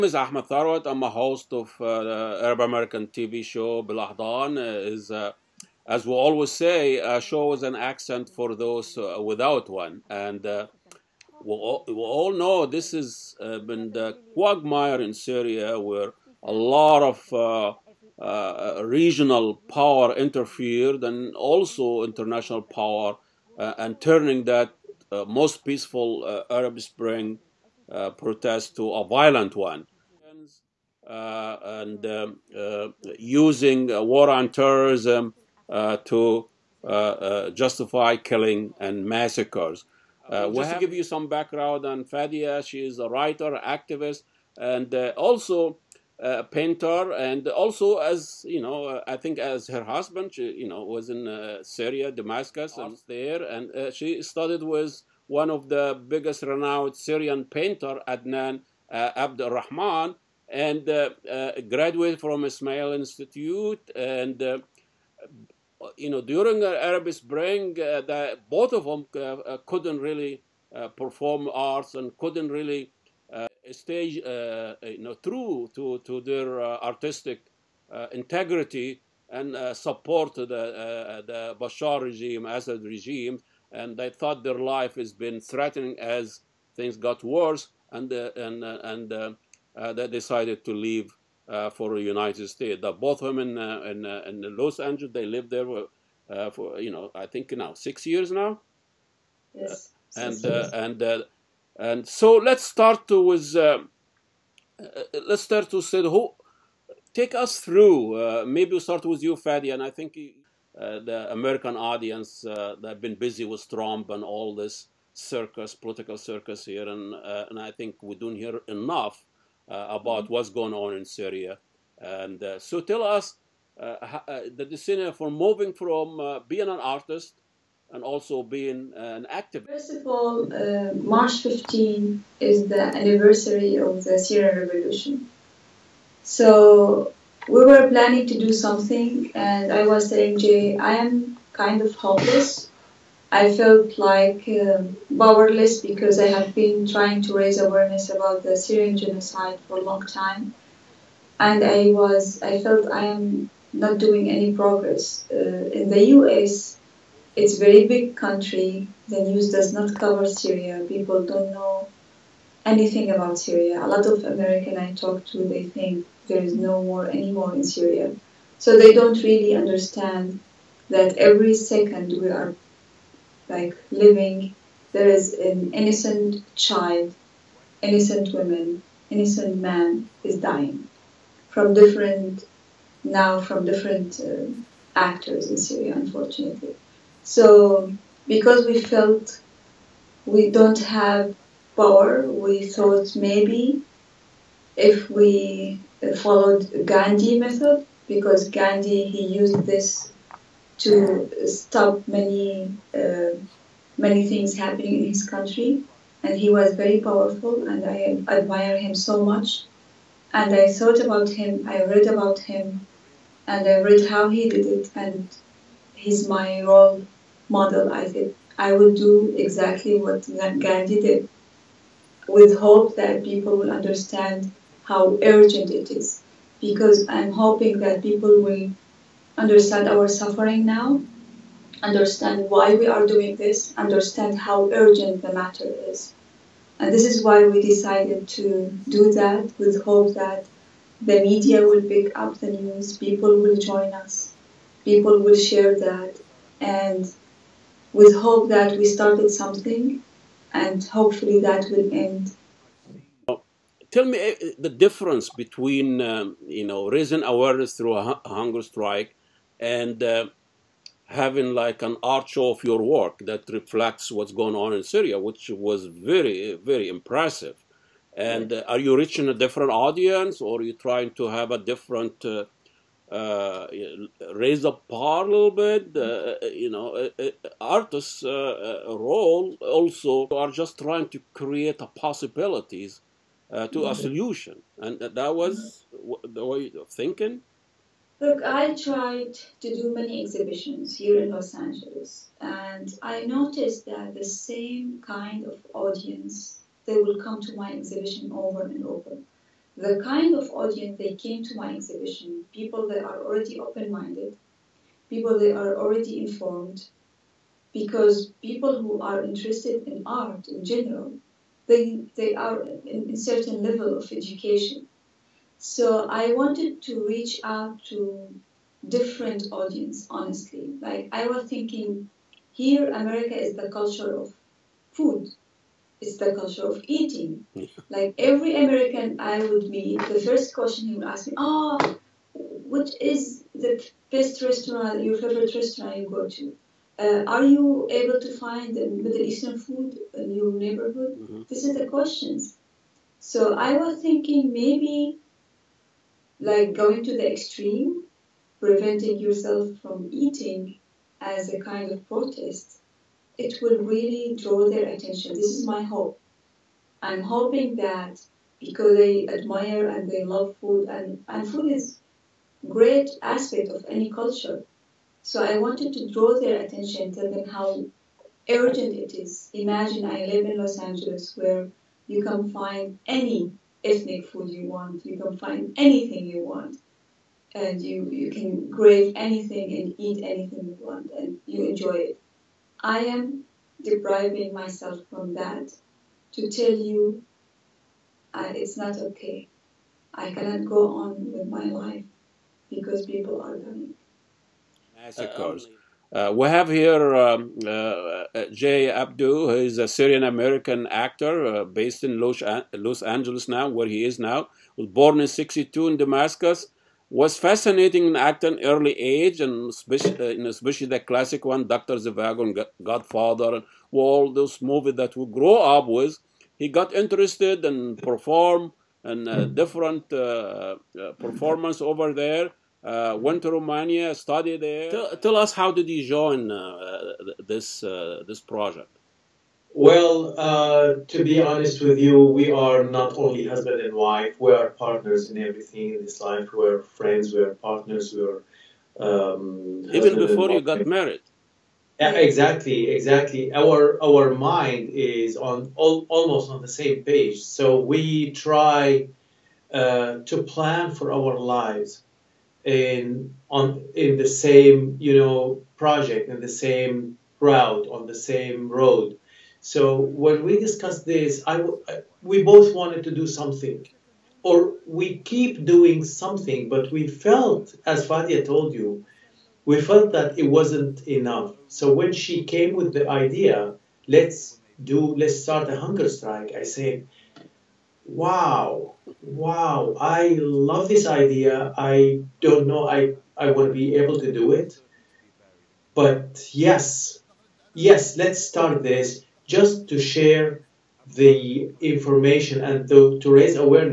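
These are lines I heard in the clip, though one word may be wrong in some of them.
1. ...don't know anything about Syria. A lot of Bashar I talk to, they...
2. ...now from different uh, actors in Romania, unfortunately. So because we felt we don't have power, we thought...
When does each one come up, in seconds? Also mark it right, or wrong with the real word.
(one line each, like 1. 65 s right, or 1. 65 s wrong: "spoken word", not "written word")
1. 161 s wrong: "American", not "Bashar"
2. 183 s wrong: "Syria", not "Romania".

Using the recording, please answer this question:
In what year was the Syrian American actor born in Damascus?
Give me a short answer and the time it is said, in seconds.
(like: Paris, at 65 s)
1962, at 405 s.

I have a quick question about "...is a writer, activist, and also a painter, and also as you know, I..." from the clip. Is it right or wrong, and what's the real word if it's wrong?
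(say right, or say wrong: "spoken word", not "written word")
right.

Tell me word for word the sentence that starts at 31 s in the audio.
Uh, and um, uh, using uh, war on terrorism uh, to justify killing and massacres.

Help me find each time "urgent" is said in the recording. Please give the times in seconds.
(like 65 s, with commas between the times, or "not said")
225 s, 234 s, 368 s.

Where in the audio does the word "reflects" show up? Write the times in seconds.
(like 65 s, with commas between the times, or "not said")
263 s.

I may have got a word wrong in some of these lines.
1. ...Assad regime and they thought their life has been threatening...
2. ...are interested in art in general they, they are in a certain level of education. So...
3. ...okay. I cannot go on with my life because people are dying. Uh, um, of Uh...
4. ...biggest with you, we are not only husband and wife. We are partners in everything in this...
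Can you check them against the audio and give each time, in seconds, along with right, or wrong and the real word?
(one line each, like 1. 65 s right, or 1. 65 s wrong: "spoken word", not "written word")
1. 82 s right
2. 309 s right
3. 388 s right
4. 431 s wrong: "honest", not "biggest".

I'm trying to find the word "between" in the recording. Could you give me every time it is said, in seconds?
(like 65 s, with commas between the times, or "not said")
255 s.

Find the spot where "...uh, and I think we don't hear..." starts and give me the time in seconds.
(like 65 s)
117 s.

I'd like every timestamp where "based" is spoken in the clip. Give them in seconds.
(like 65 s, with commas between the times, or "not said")
401 s.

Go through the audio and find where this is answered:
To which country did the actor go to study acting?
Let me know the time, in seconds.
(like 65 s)
423 s.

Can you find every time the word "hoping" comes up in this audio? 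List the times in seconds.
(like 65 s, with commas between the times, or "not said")
227 s, 357 s.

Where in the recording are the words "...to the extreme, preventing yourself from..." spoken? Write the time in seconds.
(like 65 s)
347 s.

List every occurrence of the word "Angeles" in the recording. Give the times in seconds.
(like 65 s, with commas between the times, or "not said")
94 s, 291 s, 370 s, 403 s.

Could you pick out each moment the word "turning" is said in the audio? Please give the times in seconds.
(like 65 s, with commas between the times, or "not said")
23 s.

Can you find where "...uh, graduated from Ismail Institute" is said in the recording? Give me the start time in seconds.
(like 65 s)
61 s.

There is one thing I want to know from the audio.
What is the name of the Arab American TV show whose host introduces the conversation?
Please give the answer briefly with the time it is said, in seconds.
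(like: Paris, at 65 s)
BelAhdan, at 3 s.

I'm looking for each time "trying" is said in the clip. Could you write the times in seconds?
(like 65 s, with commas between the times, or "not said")
146 s, 270 s, 280 s.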